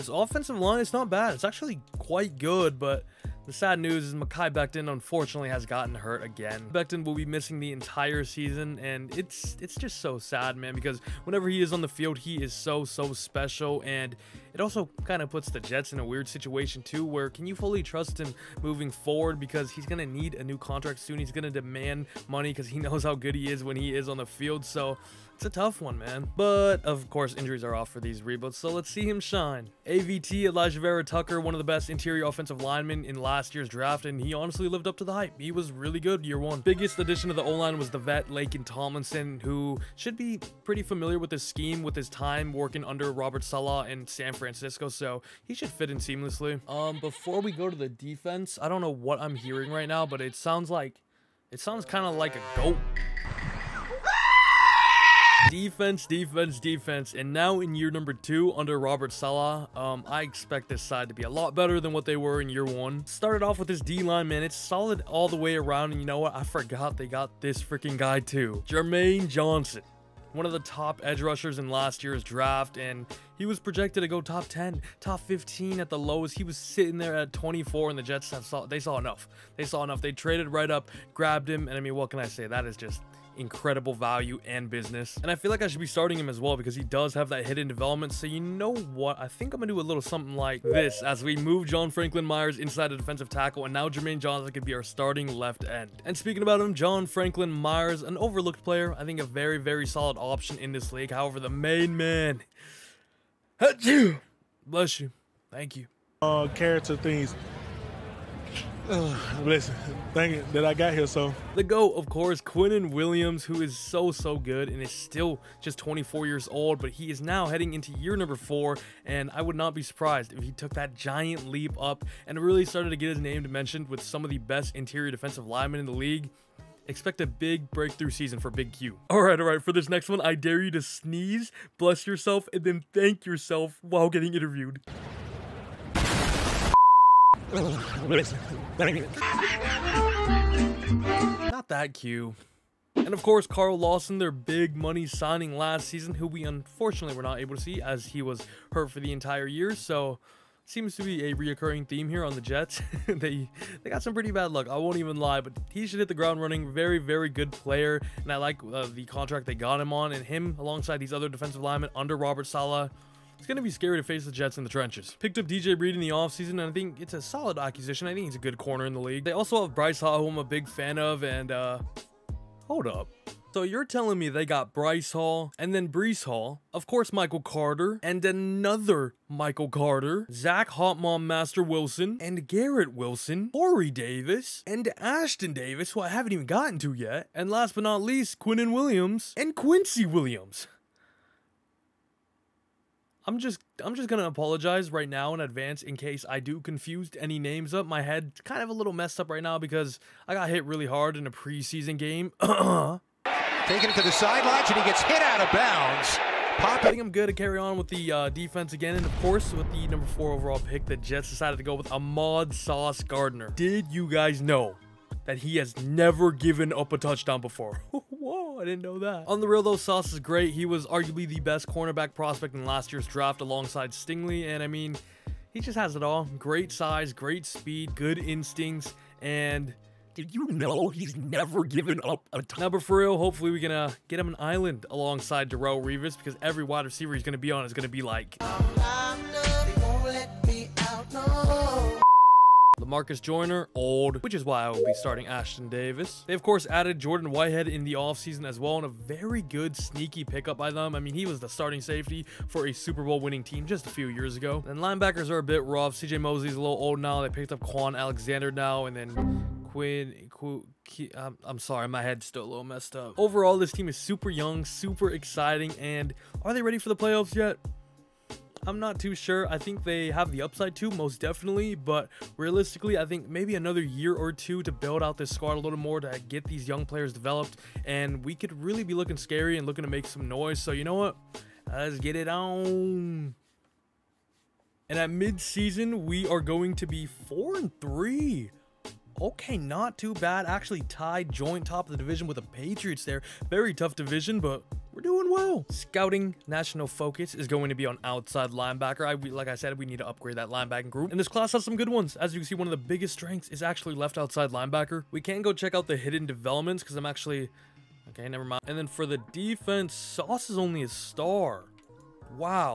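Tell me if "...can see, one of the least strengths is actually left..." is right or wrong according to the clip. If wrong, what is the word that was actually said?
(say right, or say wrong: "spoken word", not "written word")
wrong: "biggest", not "least".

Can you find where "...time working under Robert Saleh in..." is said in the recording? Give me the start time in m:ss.
0:42.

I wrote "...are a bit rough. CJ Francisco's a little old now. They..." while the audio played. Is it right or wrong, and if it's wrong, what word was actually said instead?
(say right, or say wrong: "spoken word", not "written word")
wrong: "Mosley", not "Francisco".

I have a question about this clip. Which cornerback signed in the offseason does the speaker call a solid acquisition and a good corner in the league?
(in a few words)
DJ Reed.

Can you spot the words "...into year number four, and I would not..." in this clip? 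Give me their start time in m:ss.
1:57.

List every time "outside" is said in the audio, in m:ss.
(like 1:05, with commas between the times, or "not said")
4:58, 5:04.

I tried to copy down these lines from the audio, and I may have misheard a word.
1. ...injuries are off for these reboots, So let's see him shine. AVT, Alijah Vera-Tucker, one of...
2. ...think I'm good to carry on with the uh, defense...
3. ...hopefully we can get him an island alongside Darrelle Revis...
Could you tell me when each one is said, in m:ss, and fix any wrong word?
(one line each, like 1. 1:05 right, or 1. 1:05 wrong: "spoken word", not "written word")
1. 0:27 right
2. 3:26 right
3. 3:53 right.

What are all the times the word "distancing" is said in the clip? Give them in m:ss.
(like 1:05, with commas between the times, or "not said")
not said.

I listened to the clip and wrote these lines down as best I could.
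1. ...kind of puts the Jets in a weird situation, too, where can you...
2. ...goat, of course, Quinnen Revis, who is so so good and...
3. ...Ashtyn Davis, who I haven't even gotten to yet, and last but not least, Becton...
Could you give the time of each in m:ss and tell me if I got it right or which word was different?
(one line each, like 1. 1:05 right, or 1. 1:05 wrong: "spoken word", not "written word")
1. 0:15 right
2. 1:51 wrong: "Williams", not "Revis"
3. 3:05 wrong: "Quinnen", not "Becton".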